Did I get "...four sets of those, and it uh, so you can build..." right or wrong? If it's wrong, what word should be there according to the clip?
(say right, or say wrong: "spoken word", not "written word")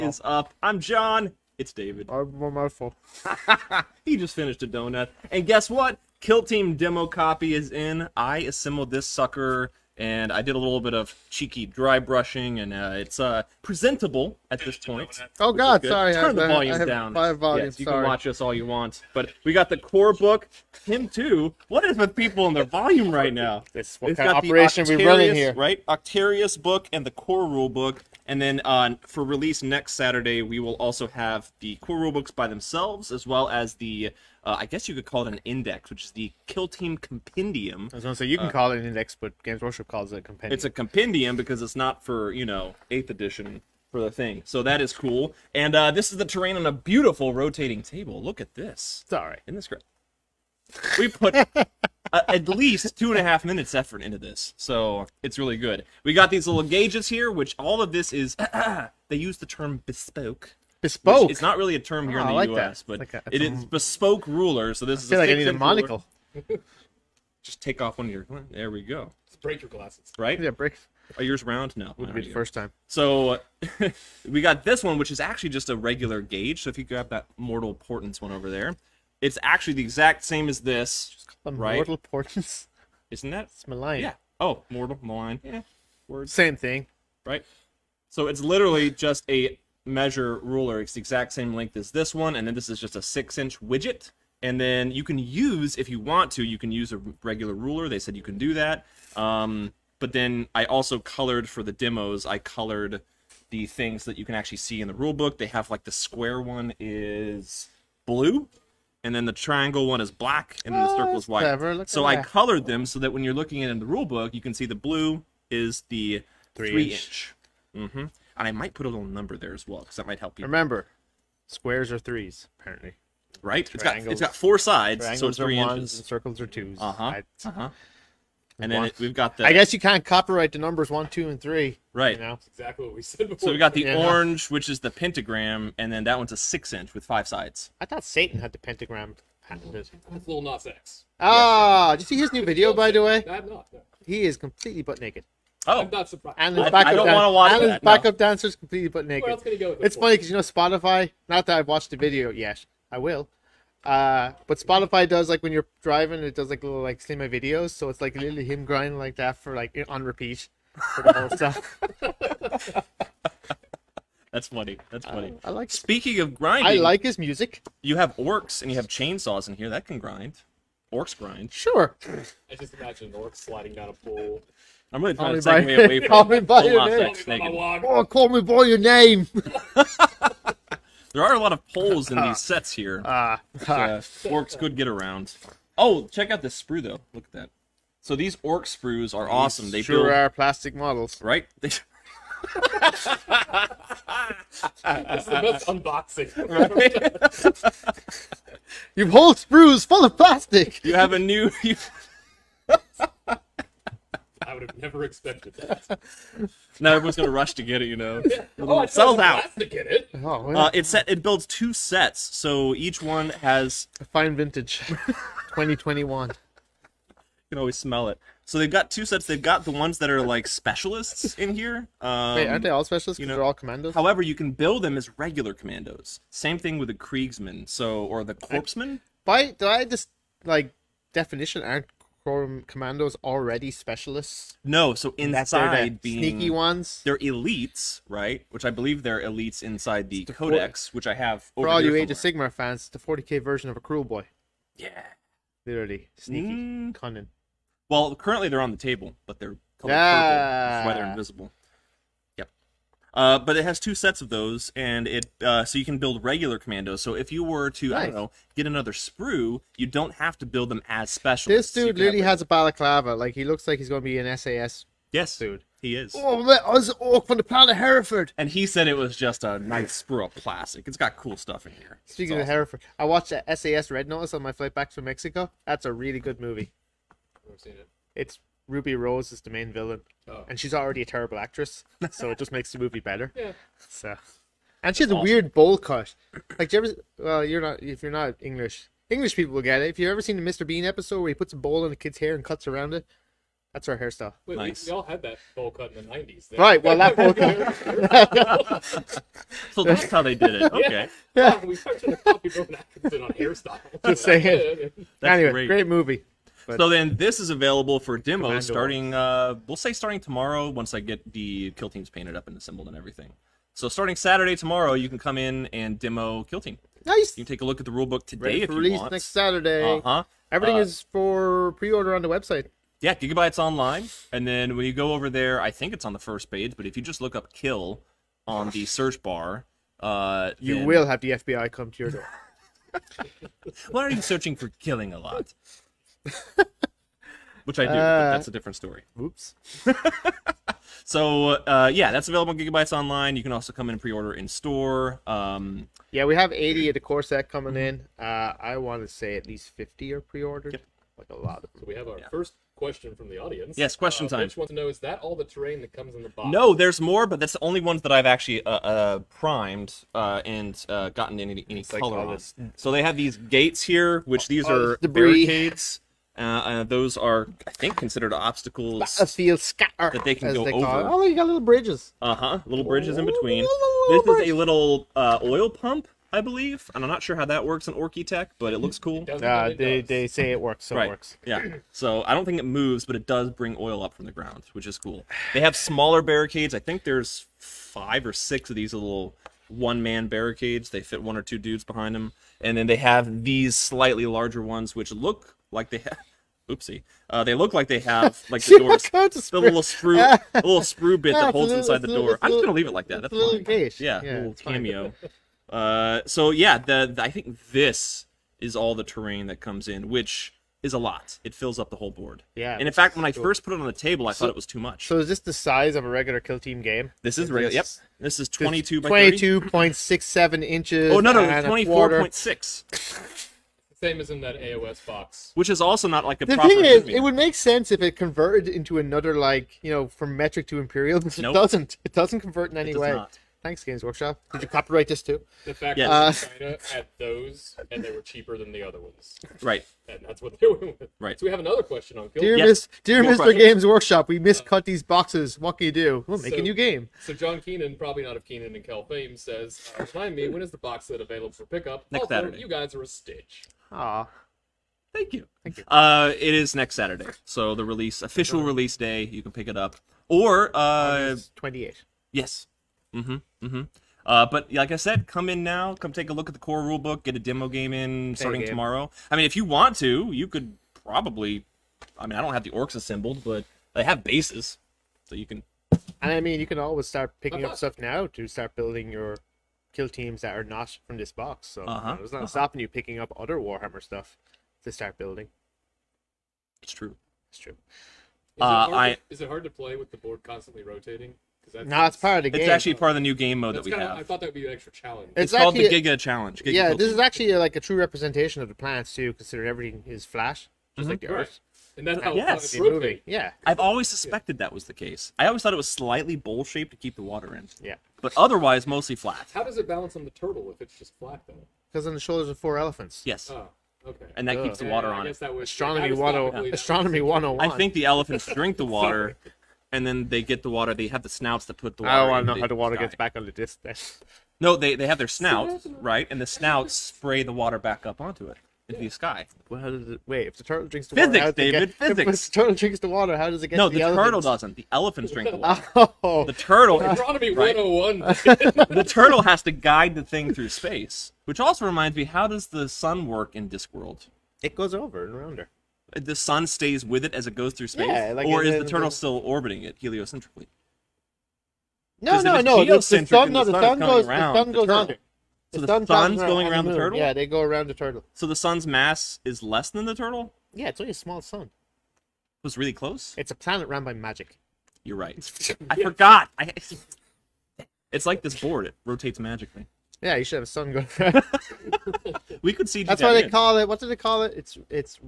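wrong: "two", not "four".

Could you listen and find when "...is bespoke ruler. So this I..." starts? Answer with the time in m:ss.
1:03.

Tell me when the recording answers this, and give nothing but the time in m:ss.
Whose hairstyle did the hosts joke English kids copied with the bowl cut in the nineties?
5:02.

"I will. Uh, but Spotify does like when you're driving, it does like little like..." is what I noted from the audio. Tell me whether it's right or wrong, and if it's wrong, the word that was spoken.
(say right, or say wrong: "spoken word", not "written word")
right.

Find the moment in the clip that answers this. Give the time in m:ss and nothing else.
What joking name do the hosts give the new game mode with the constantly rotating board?
8:15.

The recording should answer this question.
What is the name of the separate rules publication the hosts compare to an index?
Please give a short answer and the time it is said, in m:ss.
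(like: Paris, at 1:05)
Kill Team Compendium, at 0:36.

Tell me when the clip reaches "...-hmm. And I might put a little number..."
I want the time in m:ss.
1:57.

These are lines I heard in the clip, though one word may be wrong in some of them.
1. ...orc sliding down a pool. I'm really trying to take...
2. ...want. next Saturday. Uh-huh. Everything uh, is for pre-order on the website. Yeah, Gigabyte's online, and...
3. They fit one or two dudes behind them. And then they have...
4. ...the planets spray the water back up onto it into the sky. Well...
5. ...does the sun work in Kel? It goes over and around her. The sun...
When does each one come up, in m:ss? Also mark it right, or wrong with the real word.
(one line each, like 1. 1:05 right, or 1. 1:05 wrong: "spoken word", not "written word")
1. 2:53 right
2. 5:18 right
3. 6:30 right
4. 8:46 wrong: "snouts", not "planets"
5. 9:02 wrong: "Discworld", not "Kel".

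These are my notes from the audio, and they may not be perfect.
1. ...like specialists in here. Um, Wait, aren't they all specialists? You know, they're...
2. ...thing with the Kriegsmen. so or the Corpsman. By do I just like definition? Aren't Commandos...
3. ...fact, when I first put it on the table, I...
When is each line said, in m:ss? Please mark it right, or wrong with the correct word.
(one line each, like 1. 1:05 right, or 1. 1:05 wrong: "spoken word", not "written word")
1. 3:40 right
2. 3:46 right
3. 6:52 right.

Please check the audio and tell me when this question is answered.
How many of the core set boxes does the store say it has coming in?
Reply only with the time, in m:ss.
5:46.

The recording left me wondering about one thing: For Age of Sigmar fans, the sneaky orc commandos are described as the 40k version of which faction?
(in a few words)
Kruleboy.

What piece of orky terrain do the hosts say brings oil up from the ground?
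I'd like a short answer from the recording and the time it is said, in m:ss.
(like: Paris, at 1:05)
Oil pump, at 6:15.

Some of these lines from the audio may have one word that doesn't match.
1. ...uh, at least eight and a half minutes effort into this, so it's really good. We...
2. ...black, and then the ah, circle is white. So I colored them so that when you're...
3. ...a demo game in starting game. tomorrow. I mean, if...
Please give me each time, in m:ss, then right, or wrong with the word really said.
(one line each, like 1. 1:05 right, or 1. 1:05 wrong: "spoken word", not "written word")
1. 0:52 wrong: "two", not "eight"
2. 1:50 right
3. 7:47 right.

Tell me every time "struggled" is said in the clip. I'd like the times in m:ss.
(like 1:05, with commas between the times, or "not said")
not said.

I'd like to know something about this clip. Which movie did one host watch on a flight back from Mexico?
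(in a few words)
SAS Red Notice.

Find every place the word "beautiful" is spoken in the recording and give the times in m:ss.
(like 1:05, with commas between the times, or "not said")
0:46.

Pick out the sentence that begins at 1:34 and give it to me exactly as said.
And then you can use, if you want to, you can use a regular ruler.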